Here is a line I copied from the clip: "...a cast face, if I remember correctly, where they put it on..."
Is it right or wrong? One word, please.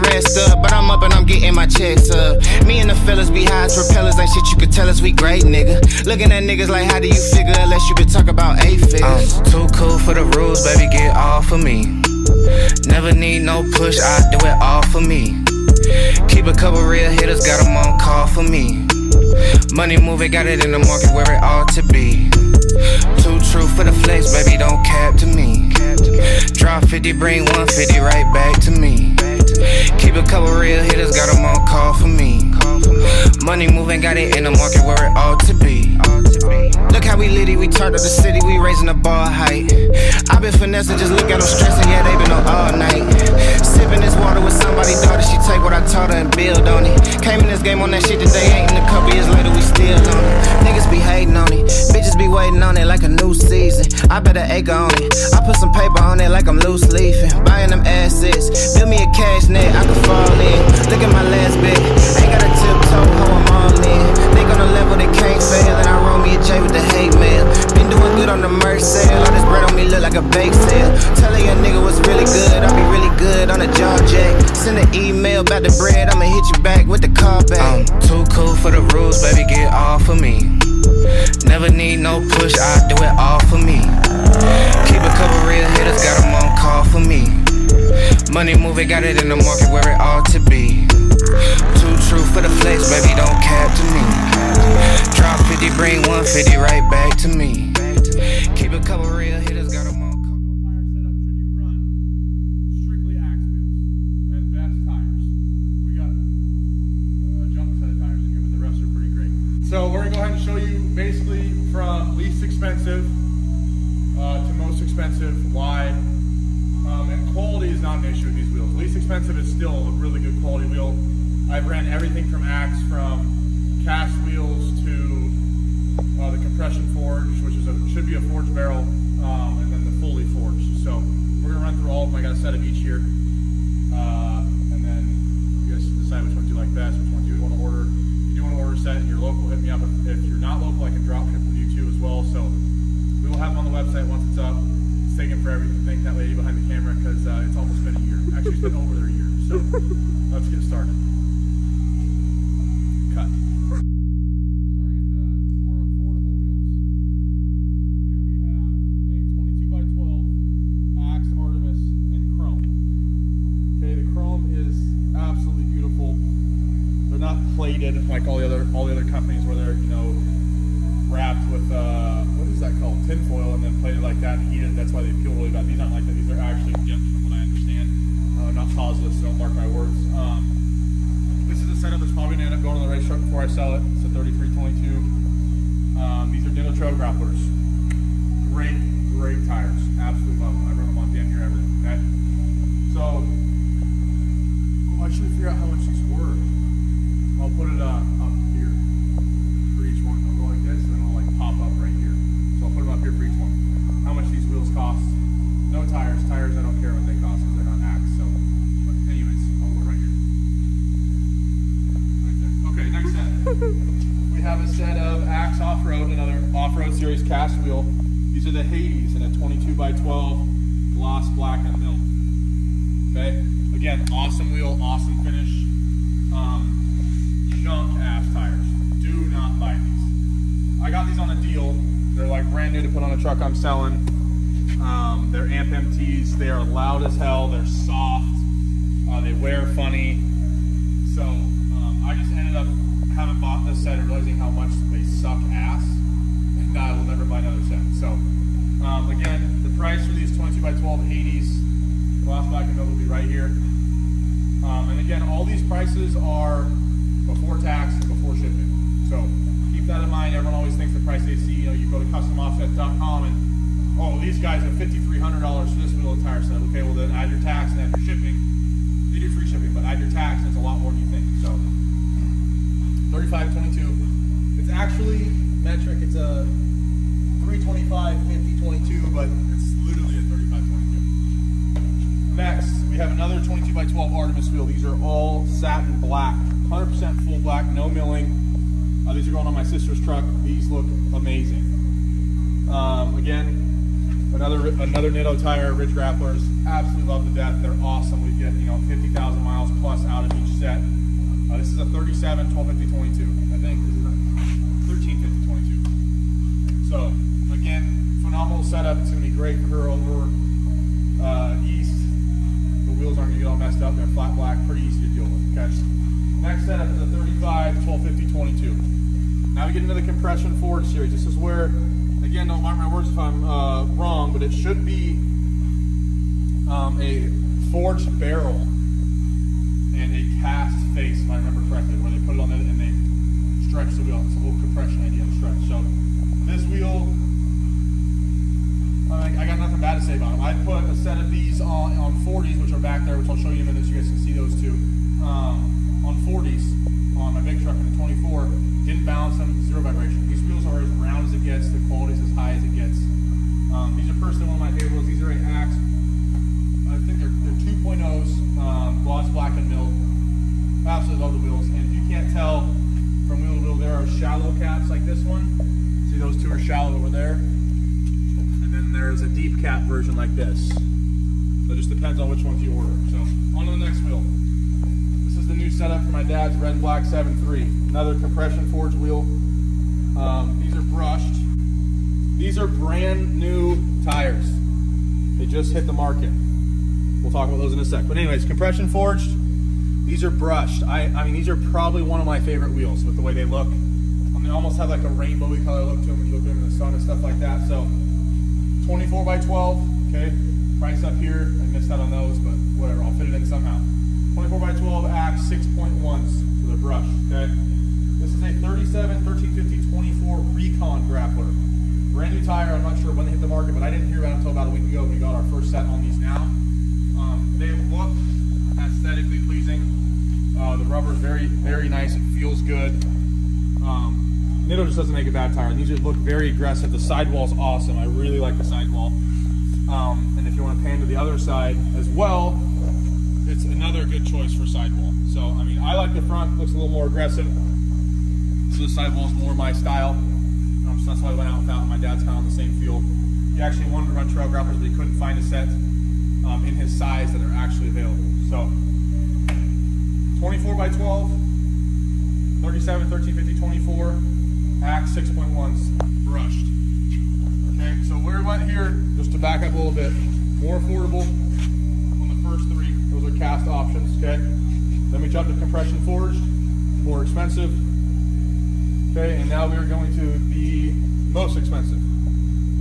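right.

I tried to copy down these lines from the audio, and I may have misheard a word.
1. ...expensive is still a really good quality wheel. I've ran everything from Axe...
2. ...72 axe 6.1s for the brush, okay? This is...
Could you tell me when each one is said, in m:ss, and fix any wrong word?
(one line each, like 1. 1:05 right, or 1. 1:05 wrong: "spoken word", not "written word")
1. 1:58 right
2. 6:44 wrong: "12", not "72".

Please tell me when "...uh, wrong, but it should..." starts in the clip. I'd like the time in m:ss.
5:23.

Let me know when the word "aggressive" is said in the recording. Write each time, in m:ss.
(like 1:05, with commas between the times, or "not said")
7:06, 7:17.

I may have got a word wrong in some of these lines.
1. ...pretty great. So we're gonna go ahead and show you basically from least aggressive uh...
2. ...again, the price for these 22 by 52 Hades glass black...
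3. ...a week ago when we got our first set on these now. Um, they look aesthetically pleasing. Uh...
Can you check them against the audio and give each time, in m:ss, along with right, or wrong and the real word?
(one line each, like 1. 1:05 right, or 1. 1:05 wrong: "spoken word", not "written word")
1. 1:48 wrong: "expensive", not "aggressive"
2. 4:09 wrong: "12", not "52"
3. 6:54 right.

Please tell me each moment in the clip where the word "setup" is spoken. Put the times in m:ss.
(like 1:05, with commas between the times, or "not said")
1:40, 3:01, 5:08, 5:16, 6:15.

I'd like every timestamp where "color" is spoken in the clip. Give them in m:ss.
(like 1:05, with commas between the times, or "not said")
6:35.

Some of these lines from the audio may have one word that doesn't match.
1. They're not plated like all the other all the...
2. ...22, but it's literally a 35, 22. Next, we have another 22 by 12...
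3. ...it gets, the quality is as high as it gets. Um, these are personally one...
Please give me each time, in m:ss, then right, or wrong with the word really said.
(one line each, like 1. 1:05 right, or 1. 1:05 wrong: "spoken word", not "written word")
1. 2:47 right
2. 4:38 right
3. 5:51 right.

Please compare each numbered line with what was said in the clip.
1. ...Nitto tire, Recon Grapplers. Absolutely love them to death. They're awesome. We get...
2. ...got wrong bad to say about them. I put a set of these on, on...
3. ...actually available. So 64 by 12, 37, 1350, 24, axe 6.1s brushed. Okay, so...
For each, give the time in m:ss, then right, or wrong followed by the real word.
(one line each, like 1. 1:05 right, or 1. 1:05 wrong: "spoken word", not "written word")
1. 4:55 wrong: "Ridge", not "Recon"
2. 5:39 wrong: "nothing", not "wrong"
3. 7:27 wrong: "24", not "64".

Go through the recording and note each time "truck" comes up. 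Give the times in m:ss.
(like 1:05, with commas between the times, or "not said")
3:03, 3:53, 4:49, 5:47.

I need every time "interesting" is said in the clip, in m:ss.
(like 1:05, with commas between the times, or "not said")
not said.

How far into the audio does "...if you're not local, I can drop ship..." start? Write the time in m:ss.
2:20.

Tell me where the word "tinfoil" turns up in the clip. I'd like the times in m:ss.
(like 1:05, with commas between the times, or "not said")
2:53.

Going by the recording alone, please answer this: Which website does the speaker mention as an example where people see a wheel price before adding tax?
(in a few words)
customoffsets.com.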